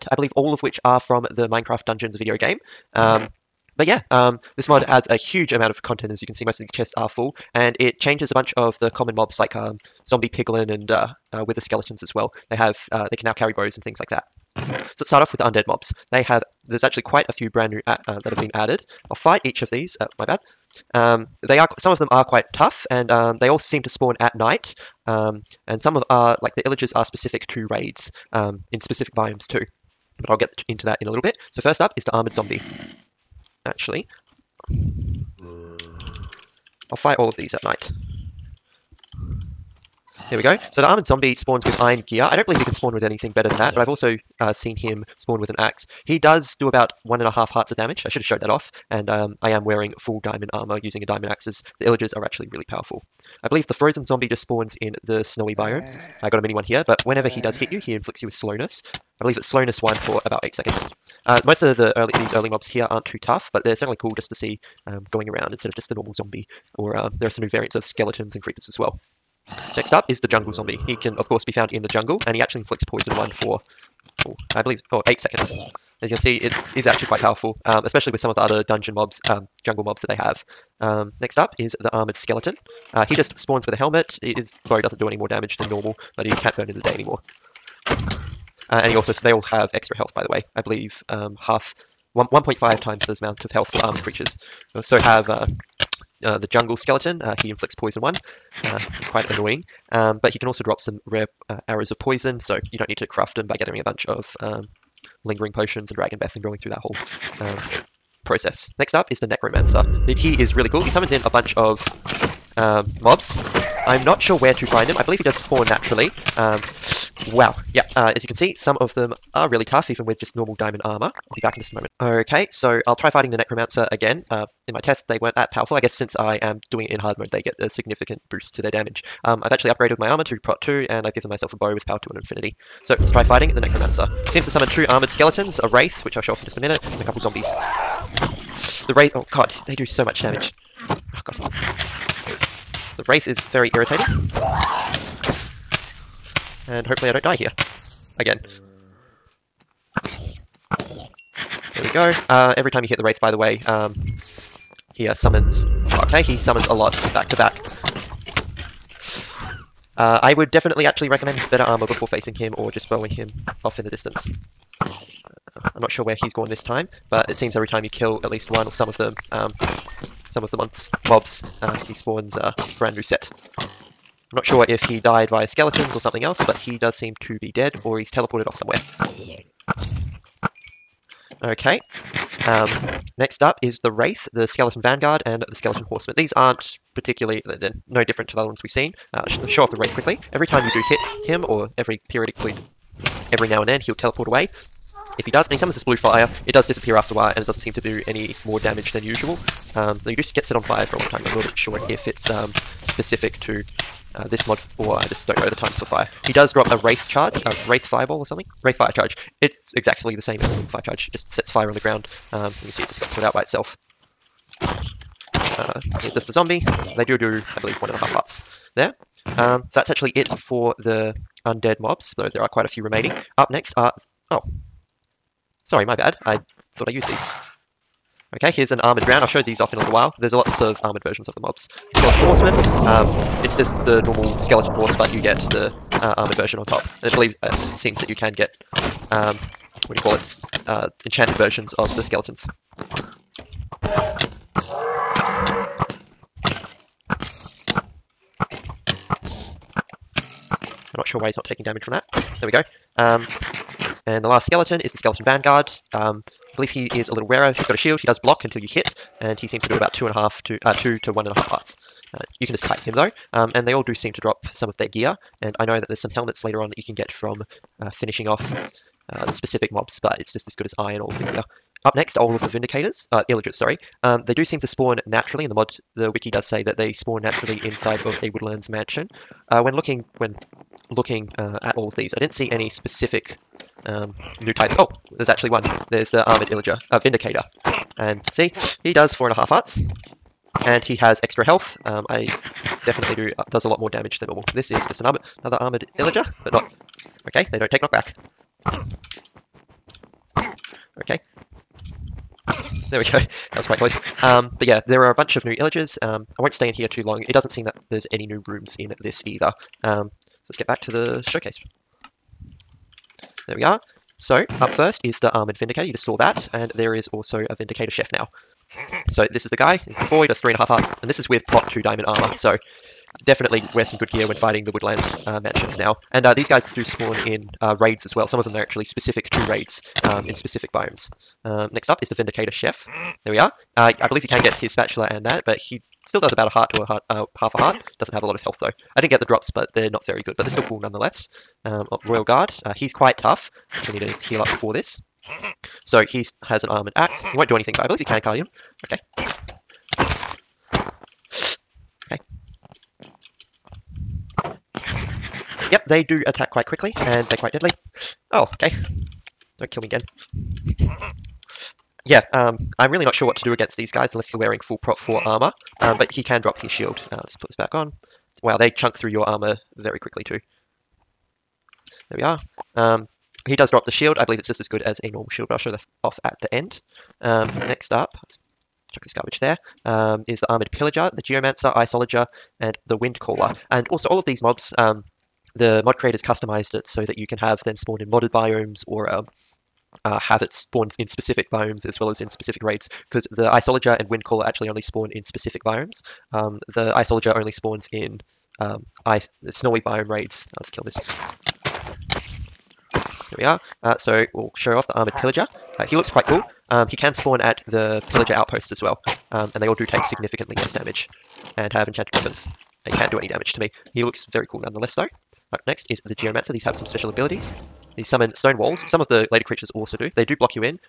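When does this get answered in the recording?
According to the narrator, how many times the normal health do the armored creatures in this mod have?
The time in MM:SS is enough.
01:32.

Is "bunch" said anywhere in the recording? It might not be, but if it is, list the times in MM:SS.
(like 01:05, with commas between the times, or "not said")
00:08, 01:43, 01:51, 05:05.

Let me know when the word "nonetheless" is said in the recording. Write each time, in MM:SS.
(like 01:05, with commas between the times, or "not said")
05:40, 06:54.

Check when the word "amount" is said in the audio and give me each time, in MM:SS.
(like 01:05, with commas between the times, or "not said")
00:05, 01:33.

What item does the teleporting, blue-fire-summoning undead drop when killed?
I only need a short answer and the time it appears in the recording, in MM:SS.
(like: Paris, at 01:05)
Wraith fire charge, at 03:28.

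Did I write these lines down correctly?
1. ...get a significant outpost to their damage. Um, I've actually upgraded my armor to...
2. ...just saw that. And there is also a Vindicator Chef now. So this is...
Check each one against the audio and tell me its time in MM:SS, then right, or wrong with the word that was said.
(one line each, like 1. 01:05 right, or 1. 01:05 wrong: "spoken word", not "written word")
1. 02:07 wrong: "boost", not "outpost"
2. 05:15 right.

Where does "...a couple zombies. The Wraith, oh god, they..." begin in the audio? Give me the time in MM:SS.
02:17.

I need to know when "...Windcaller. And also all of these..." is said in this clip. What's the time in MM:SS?
06:22.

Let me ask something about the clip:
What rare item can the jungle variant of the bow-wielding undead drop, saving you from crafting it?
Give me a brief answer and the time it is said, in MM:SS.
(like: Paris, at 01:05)
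Arrows of poison, at 01:41.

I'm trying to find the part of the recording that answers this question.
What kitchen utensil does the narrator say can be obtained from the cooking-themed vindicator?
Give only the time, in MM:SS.
05:34.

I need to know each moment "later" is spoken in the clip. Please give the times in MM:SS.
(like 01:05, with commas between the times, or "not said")
04:26, 06:59.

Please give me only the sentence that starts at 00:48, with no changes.
I should have showed that off.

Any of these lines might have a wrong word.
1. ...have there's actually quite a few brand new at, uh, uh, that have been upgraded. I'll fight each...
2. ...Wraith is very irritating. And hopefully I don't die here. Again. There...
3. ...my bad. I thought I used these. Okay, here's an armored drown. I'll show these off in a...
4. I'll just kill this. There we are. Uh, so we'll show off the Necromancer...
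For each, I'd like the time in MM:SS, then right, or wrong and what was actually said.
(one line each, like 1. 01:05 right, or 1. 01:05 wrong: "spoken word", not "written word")
1. 00:16 wrong: "added", not "upgraded"
2. 02:23 right
3. 03:45 right
4. 06:40 wrong: "Armored", not "Necromancer".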